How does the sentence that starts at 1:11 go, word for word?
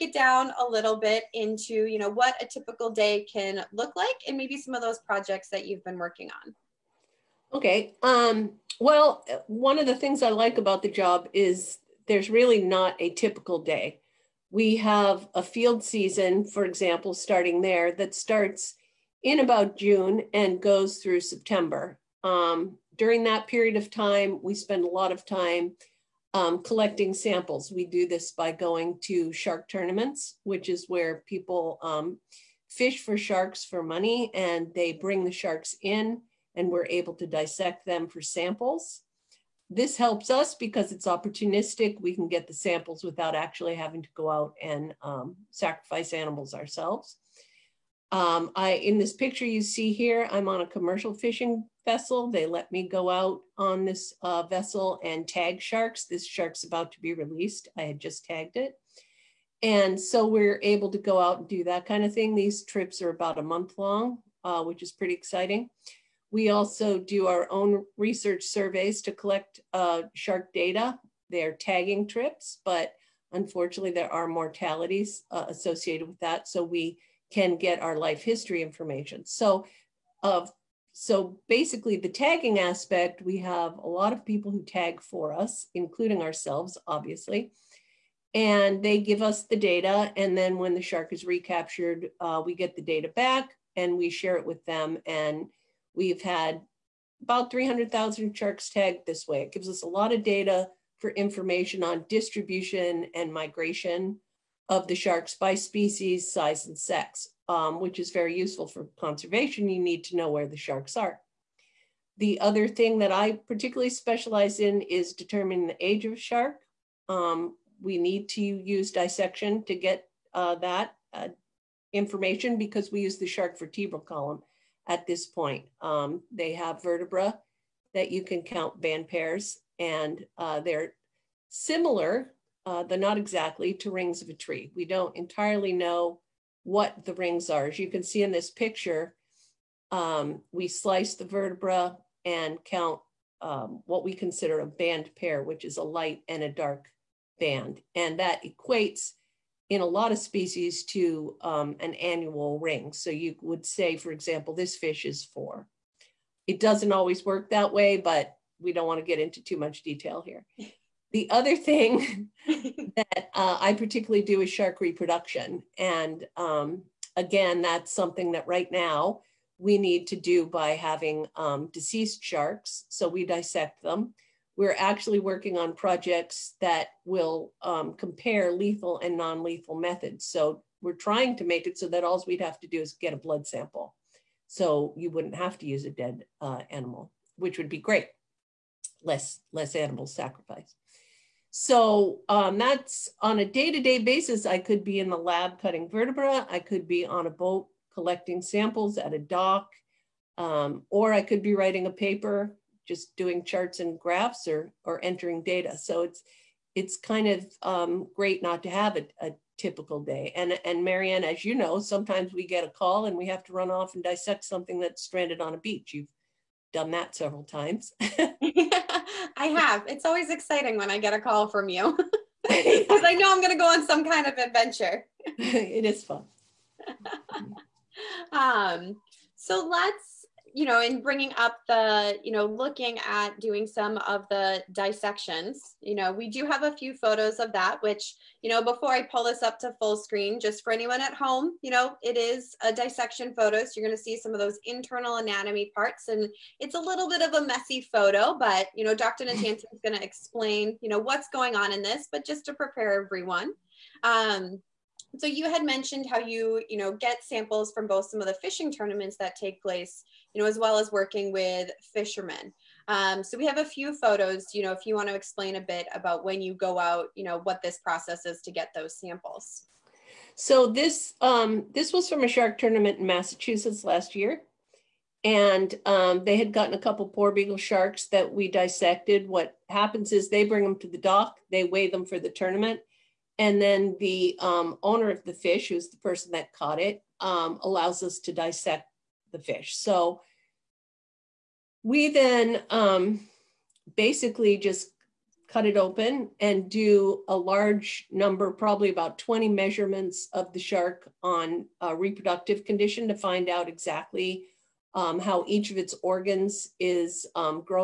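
They're tagging trips, but unfortunately there are mortalities uh, associated with that.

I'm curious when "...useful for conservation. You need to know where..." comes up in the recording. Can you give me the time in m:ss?
1:48.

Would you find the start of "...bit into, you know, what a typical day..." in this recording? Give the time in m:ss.
0:00.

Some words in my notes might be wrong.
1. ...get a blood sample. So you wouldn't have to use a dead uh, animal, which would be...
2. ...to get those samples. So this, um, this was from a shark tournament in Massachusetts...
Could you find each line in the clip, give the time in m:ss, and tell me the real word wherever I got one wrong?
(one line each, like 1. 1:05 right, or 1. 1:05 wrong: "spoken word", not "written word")
1. 3:02 right
2. 4:28 right.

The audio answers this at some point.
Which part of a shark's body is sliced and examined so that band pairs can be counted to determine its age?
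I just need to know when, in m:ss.
2:03.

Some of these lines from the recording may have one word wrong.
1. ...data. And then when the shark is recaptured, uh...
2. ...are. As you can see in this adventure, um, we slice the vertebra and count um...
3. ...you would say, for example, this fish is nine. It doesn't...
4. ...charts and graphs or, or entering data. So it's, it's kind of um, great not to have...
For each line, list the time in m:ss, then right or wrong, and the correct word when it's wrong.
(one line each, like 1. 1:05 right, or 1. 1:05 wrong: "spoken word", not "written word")
1. 1:29 right
2. 2:17 wrong: "picture", not "adventure"
3. 2:33 wrong: "four", not "nine"
4. 3:23 right.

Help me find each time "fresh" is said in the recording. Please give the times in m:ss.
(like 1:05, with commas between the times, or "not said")
not said.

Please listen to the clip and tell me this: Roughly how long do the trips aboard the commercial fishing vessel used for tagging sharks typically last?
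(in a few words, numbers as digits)
About a month.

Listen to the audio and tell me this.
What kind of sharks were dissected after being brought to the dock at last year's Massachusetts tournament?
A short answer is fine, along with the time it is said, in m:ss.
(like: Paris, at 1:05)
Porbeagle sharks, at 4:37.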